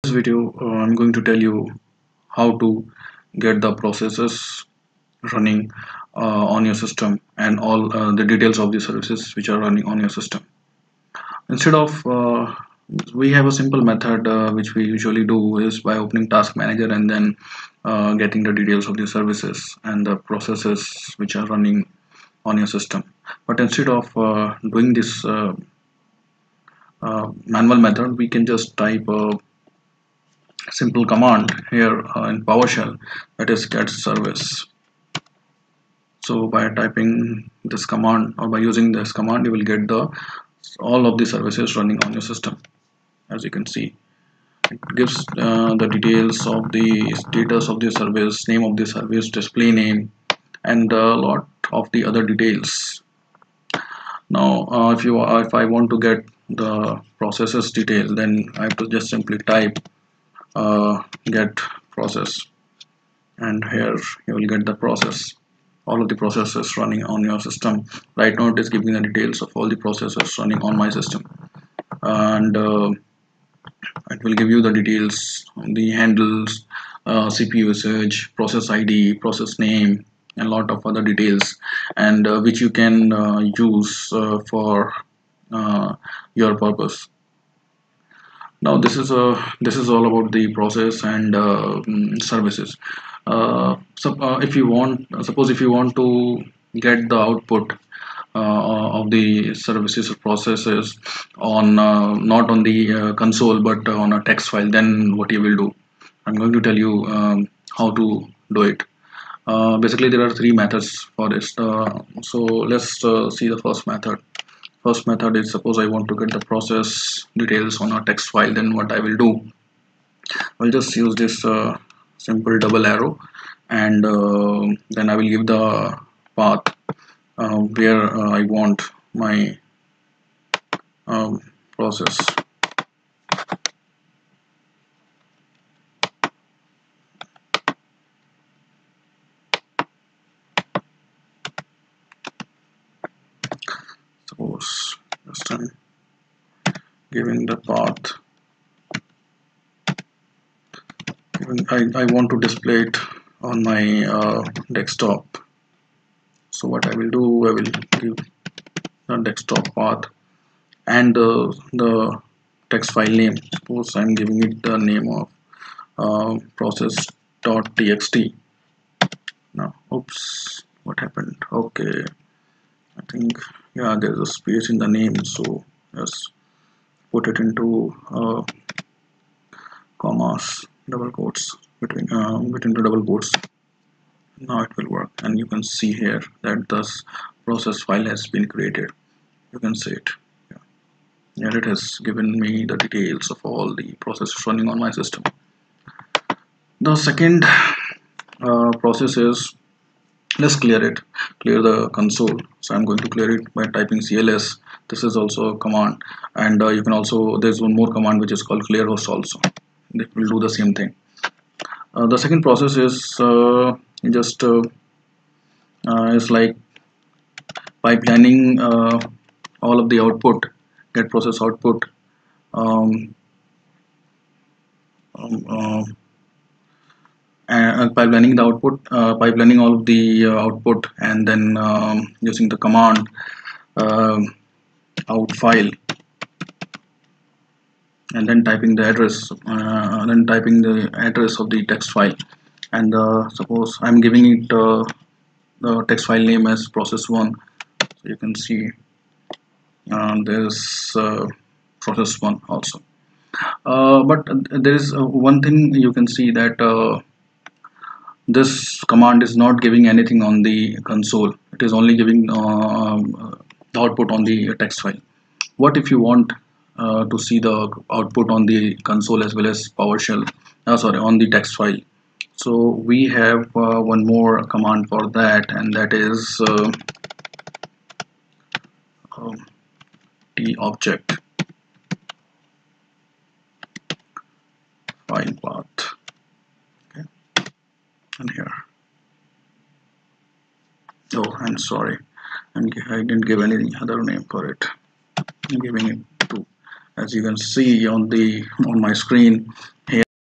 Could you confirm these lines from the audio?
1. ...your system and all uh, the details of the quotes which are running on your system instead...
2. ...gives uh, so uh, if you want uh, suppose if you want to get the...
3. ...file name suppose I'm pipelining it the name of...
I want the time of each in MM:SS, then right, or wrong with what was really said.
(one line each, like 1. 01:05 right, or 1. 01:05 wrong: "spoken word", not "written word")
1. 00:06 wrong: "services", not "quotes"
2. 01:32 wrong: "services", not "gives"
3. 02:42 wrong: "giving", not "pipelining".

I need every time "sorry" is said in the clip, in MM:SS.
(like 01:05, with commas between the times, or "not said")
04:30, 04:51.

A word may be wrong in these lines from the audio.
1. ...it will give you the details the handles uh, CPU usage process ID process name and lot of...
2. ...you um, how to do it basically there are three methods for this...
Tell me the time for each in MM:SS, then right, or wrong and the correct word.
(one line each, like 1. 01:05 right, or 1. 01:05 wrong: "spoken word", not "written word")
1. 01:14 right
2. 01:46 right.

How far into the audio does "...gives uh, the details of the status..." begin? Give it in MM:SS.
00:44.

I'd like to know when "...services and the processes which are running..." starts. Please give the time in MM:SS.
00:19.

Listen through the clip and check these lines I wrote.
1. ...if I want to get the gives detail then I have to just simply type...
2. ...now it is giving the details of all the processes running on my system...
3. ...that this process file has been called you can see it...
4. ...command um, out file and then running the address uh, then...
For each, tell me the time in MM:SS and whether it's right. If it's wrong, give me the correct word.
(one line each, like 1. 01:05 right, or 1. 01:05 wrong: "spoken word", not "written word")
1. 00:55 wrong: "processes", not "gives"
2. 01:08 right
3. 03:06 wrong: "created", not "called"
4. 03:52 wrong: "typing", not "running".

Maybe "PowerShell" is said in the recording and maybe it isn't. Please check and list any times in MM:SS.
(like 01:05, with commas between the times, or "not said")
00:32, 04:29.